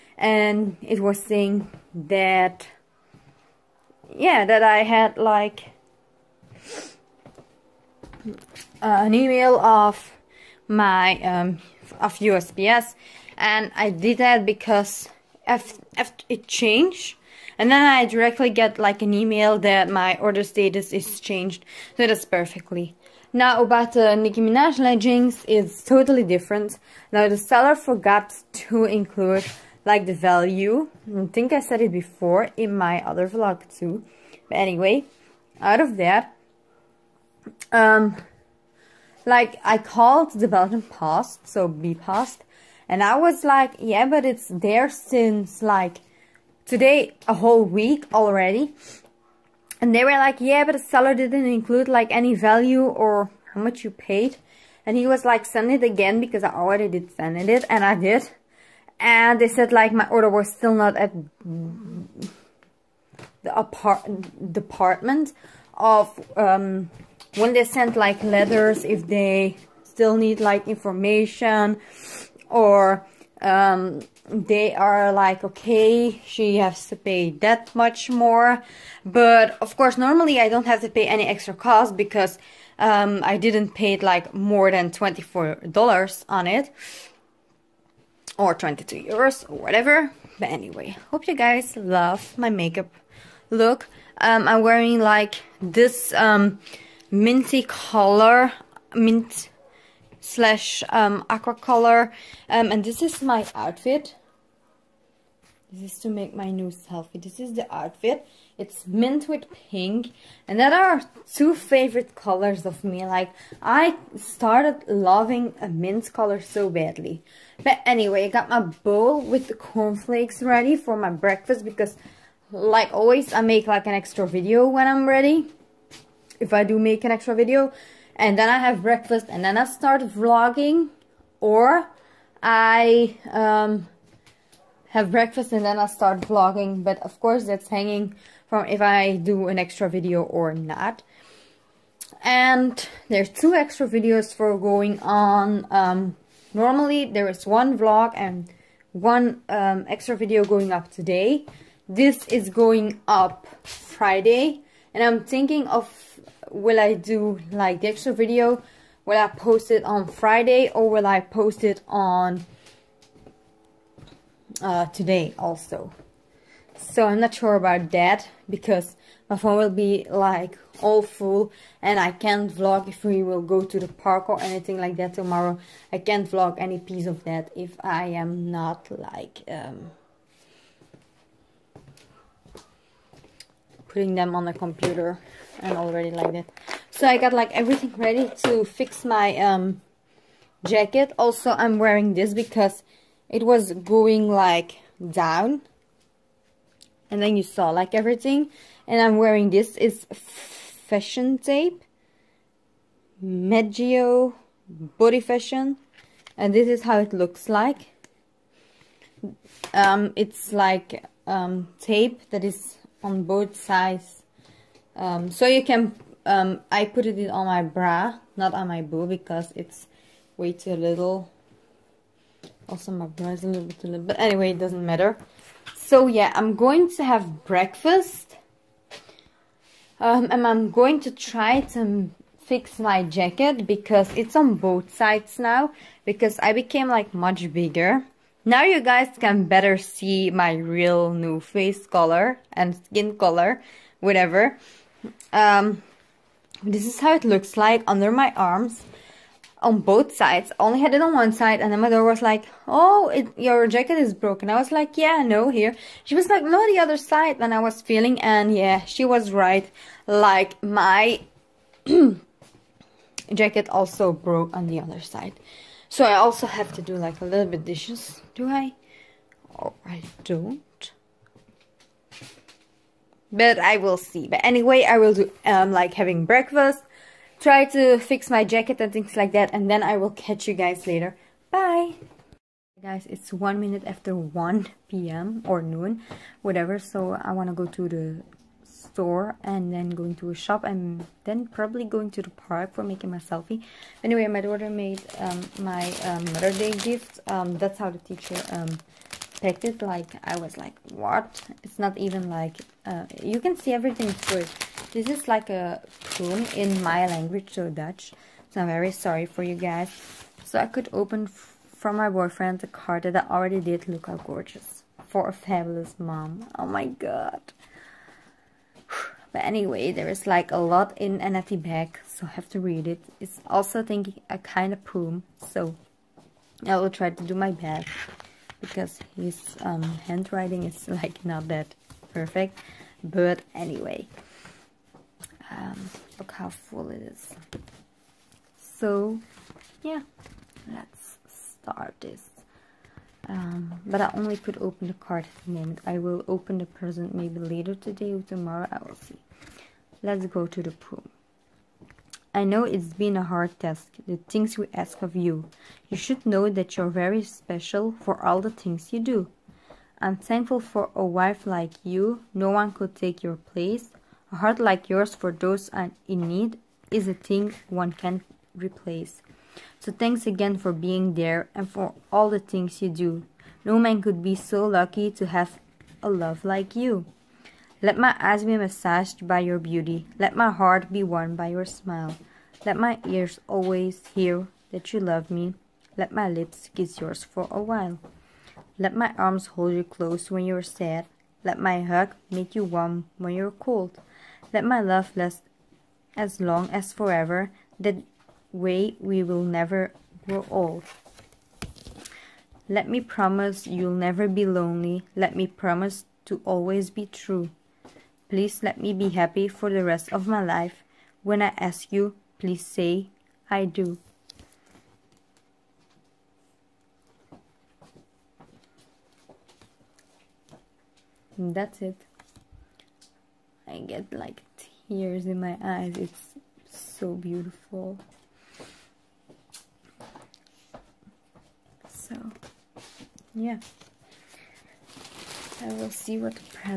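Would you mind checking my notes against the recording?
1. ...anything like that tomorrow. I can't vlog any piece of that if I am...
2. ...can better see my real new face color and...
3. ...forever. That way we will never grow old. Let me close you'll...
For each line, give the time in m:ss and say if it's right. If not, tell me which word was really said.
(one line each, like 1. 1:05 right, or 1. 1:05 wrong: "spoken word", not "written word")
1. 2:54 right
2. 3:59 right
3. 6:36 wrong: "promise", not "close".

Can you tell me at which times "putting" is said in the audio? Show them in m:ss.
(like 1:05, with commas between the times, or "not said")
3:03.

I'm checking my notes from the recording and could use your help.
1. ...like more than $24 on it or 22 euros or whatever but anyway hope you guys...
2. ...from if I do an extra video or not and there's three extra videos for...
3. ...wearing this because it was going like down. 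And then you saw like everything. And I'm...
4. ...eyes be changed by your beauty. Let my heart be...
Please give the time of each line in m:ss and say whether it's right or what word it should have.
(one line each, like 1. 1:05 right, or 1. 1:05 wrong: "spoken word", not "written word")
1. 1:24 right
2. 2:18 wrong: "two", not "three"
3. 3:11 right
4. 6:18 wrong: "massaged", not "changed".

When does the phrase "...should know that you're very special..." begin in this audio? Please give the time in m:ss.
5:55.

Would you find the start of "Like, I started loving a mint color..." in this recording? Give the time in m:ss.
1:53.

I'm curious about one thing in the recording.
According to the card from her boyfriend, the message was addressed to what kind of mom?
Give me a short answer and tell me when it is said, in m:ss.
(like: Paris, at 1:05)
A fabulous mom, at 5:15.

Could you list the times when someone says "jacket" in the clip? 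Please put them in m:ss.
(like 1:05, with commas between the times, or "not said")
3:10, 3:53, 4:13, 4:23, 4:38.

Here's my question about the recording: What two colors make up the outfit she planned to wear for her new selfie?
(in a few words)
Mint with pink.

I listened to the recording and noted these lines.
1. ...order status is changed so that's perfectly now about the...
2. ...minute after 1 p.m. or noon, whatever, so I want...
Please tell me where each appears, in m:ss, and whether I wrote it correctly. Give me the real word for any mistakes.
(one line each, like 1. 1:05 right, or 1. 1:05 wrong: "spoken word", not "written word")
1. 0:20 right
2. 4:43 right.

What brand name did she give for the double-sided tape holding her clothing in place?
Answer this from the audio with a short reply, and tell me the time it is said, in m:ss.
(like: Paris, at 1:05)
Meggio, at 3:23.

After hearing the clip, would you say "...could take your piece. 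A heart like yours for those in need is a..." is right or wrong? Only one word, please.
wrong.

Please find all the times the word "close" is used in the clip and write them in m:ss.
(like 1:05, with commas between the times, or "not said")
6:29.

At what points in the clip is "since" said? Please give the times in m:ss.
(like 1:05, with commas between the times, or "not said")
0:44.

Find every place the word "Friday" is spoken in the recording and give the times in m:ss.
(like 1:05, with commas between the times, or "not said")
2:33, 2:40.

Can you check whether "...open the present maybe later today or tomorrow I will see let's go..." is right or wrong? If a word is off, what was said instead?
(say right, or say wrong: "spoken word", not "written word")
right.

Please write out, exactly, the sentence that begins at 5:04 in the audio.
This is like a poem in my language, so Dutch.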